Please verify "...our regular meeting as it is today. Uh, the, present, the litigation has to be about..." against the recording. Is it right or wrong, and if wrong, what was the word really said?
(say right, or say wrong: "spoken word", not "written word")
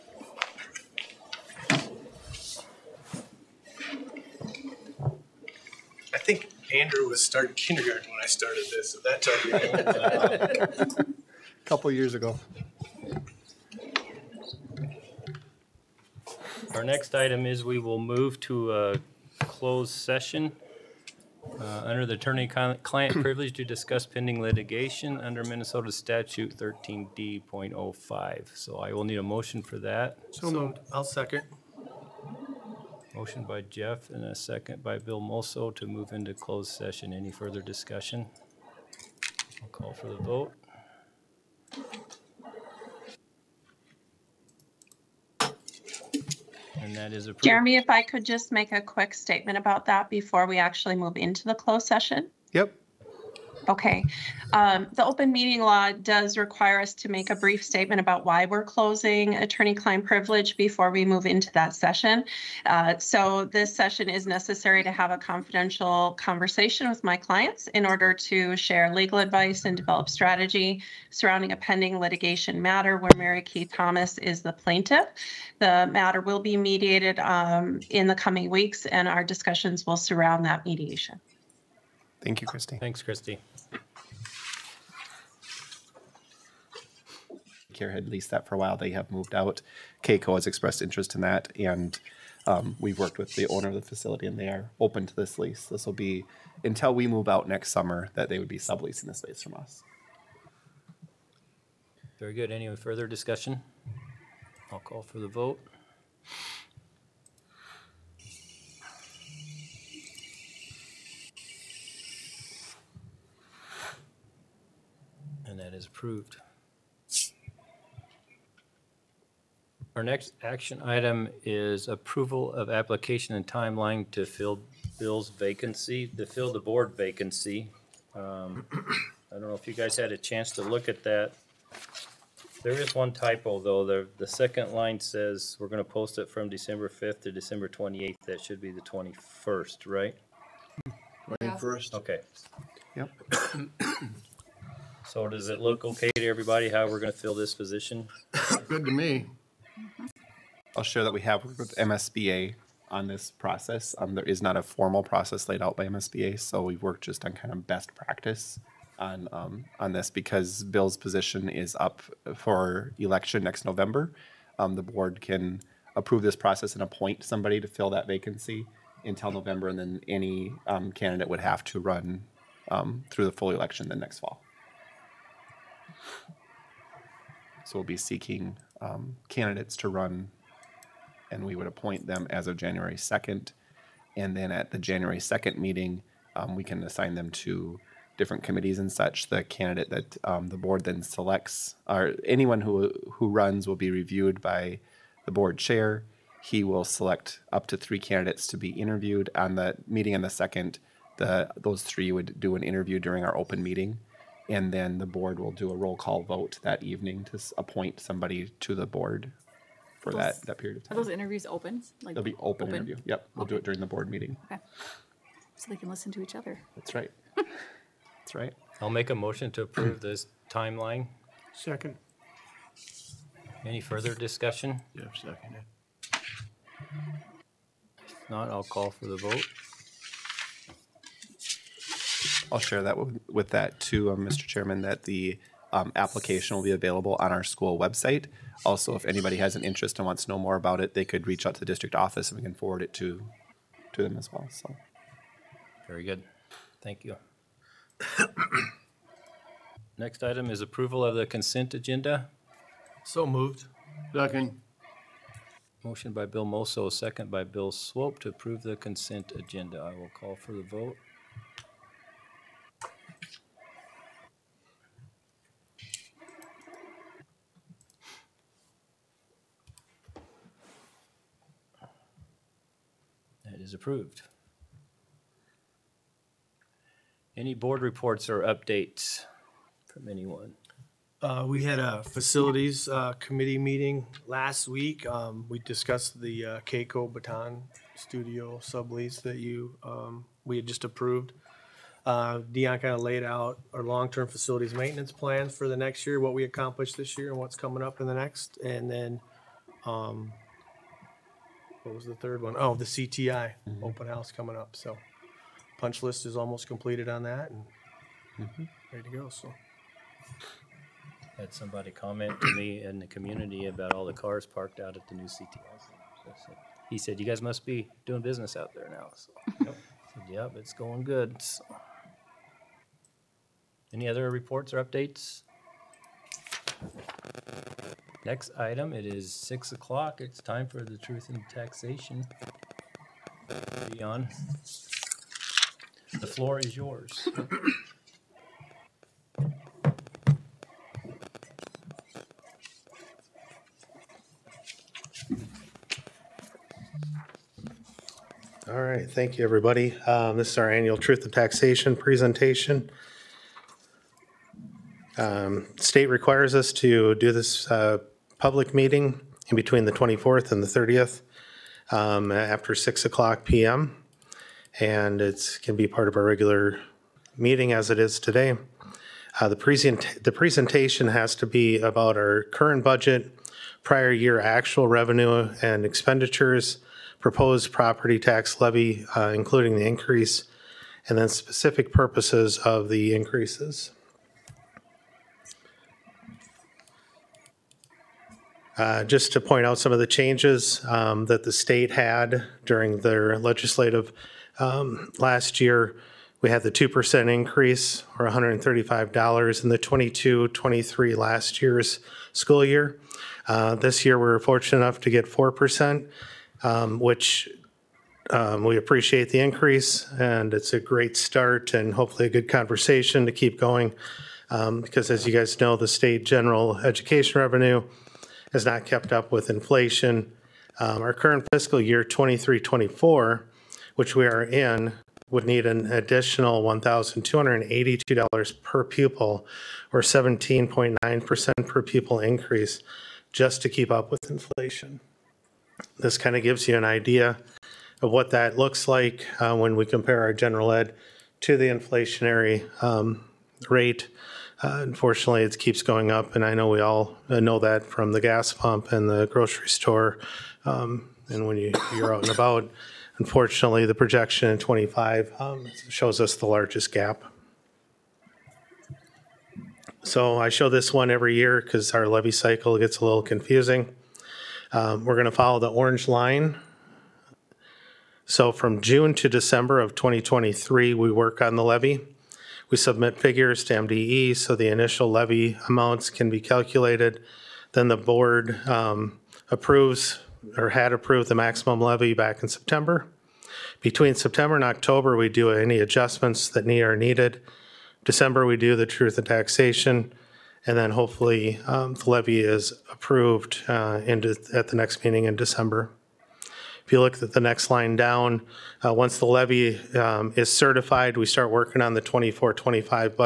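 wrong: "presentation", not "litigation".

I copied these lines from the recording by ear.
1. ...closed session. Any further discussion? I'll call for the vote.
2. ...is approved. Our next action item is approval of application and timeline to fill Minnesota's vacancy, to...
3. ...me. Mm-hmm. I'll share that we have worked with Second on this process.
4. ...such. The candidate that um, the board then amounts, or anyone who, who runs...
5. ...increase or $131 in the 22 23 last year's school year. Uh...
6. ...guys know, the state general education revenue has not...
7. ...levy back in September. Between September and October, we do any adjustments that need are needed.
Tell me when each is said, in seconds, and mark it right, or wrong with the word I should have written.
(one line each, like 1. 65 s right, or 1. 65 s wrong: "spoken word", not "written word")
1. 36 s right
2. 115 s wrong: "Bill", not "Minnesota"
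3. 148 s wrong: "MSBA", not "Second"
4. 188 s wrong: "selects", not "amounts"
5. 397 s wrong: "135", not "131"
6. 415 s right
7. 481 s right.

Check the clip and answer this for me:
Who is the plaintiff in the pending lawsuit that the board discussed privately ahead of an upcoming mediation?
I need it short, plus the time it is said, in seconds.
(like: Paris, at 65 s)
Mary Kay Thomas, at 73 s.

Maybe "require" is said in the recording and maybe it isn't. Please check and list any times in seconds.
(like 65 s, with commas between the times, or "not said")
56 s, 356 s.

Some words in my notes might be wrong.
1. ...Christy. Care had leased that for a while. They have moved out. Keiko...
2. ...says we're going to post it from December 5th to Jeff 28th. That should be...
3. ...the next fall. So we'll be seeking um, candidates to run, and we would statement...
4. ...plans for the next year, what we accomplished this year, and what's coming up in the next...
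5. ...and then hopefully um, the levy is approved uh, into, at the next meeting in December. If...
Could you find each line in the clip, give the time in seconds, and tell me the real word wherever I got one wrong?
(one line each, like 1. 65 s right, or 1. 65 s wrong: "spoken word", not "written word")
1. 83 s right
2. 135 s wrong: "December", not "Jeff"
3. 173 s wrong: "appoint", not "statement"
4. 295 s right
5. 490 s right.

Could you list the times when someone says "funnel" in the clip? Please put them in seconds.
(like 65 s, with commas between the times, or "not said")
not said.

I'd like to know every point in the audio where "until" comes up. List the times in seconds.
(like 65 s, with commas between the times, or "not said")
96 s, 169 s.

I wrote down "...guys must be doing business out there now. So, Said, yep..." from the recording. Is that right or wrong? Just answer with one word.
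right.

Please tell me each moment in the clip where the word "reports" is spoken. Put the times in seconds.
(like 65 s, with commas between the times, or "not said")
277 s, 324 s.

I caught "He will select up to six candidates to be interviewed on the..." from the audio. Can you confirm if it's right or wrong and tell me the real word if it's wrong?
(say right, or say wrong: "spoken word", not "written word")
wrong: "three", not "six".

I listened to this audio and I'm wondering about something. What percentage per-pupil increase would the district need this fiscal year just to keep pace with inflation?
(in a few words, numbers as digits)
17.9%.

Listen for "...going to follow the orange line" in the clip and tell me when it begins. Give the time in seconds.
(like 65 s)
465 s.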